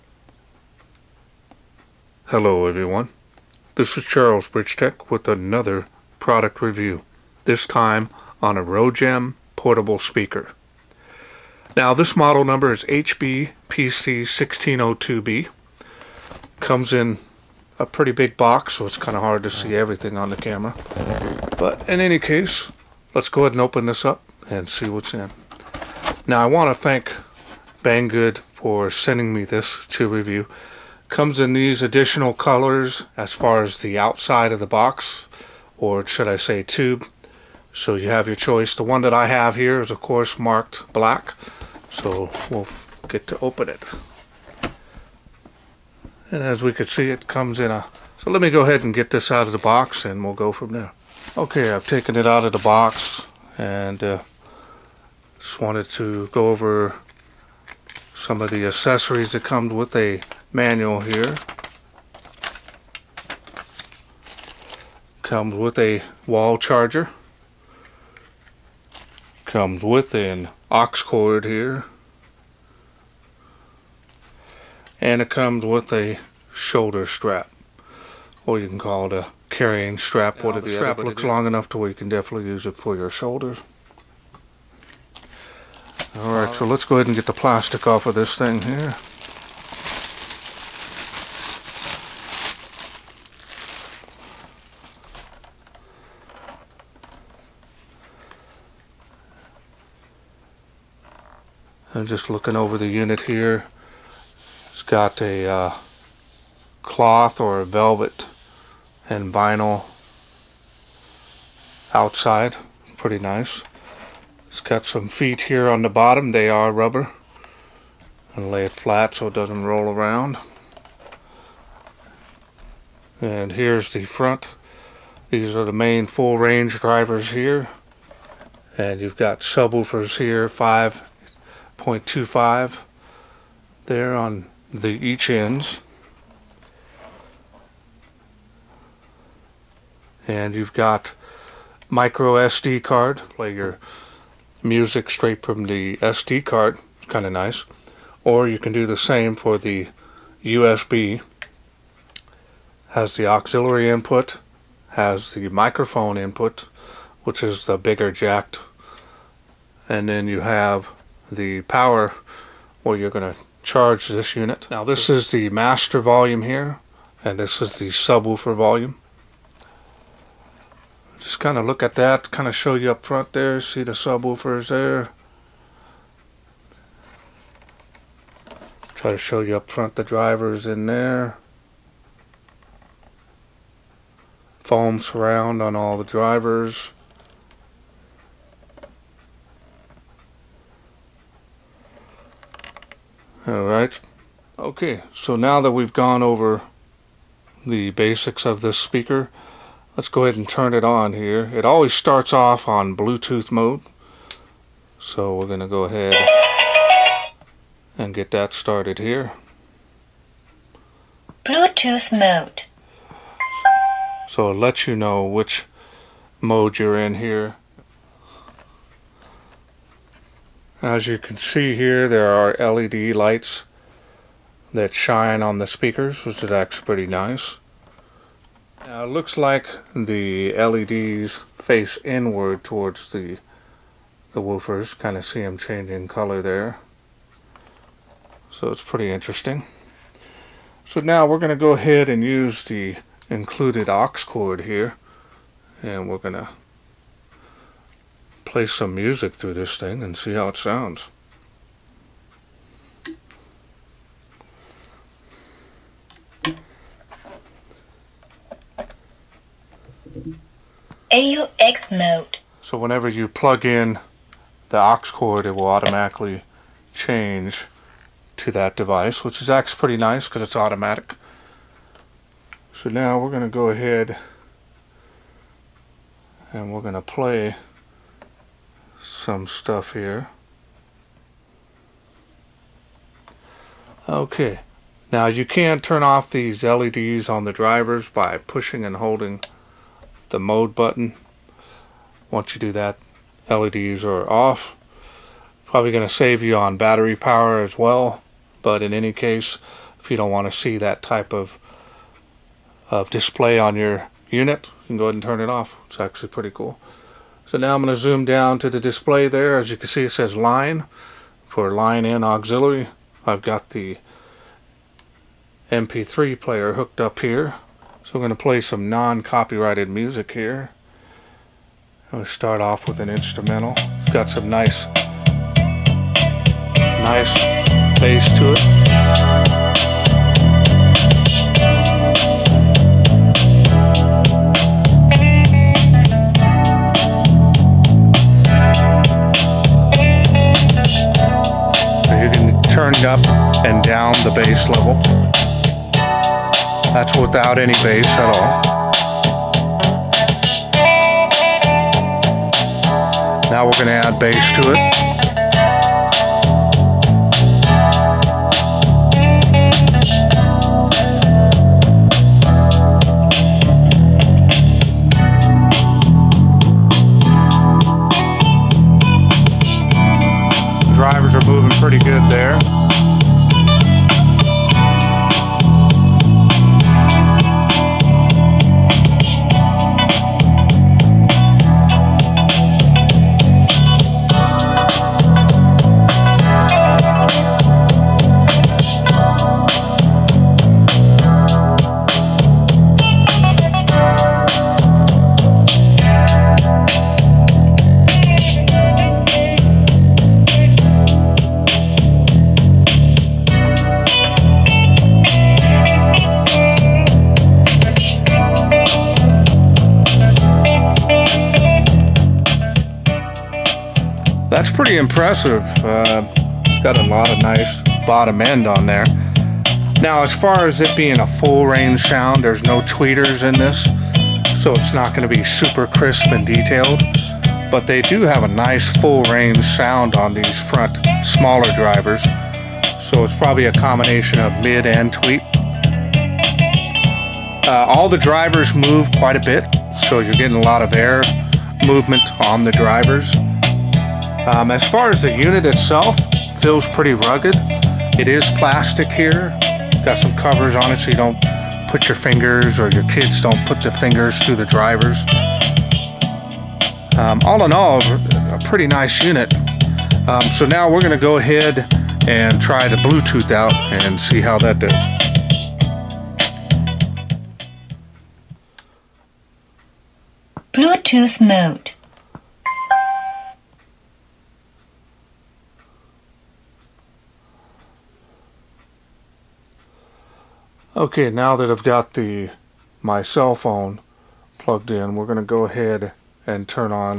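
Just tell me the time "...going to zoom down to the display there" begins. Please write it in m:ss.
5:07.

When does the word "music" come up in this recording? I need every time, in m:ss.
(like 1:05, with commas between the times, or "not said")
2:24, 4:08, 5:19.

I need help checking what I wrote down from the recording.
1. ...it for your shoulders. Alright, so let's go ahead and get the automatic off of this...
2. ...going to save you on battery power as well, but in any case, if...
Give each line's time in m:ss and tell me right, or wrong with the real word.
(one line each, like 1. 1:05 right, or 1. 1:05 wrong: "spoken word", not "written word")
1. 1:22 wrong: "plastic", not "automatic"
2. 4:55 right.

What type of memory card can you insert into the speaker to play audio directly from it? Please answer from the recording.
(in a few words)
Micro SD card.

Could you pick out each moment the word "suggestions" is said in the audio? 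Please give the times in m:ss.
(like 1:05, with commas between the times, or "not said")
not said.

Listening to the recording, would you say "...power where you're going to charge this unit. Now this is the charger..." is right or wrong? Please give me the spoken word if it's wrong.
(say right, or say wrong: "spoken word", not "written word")
wrong: "master", not "charger".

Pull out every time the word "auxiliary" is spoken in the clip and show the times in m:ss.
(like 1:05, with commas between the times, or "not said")
2:33, 5:12.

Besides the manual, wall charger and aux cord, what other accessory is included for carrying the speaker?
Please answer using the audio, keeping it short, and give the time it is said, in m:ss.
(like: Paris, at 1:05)
Shoulder strap, at 1:16.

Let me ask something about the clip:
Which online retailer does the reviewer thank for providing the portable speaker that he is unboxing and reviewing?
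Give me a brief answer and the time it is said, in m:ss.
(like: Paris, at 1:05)
Banggood, at 0:27.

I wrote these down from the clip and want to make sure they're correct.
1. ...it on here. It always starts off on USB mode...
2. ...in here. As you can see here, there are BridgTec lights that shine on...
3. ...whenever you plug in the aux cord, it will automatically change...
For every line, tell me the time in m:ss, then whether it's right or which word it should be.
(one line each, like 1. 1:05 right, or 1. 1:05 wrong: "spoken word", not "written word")
1. 3:20 wrong: "Bluetooth", not "USB"
2. 3:36 wrong: "LED", not "BridgTec"
3. 4:22 right.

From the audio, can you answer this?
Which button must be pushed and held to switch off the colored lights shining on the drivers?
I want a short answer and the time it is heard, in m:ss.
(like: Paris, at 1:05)
Mode button, at 4:50.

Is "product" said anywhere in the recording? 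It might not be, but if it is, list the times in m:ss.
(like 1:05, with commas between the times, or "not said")
0:06.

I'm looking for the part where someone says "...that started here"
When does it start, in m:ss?
3:28.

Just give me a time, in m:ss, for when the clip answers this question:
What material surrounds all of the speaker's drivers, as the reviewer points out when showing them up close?
3:04.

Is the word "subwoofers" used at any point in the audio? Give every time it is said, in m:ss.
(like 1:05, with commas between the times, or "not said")
2:09, 2:47, 2:53.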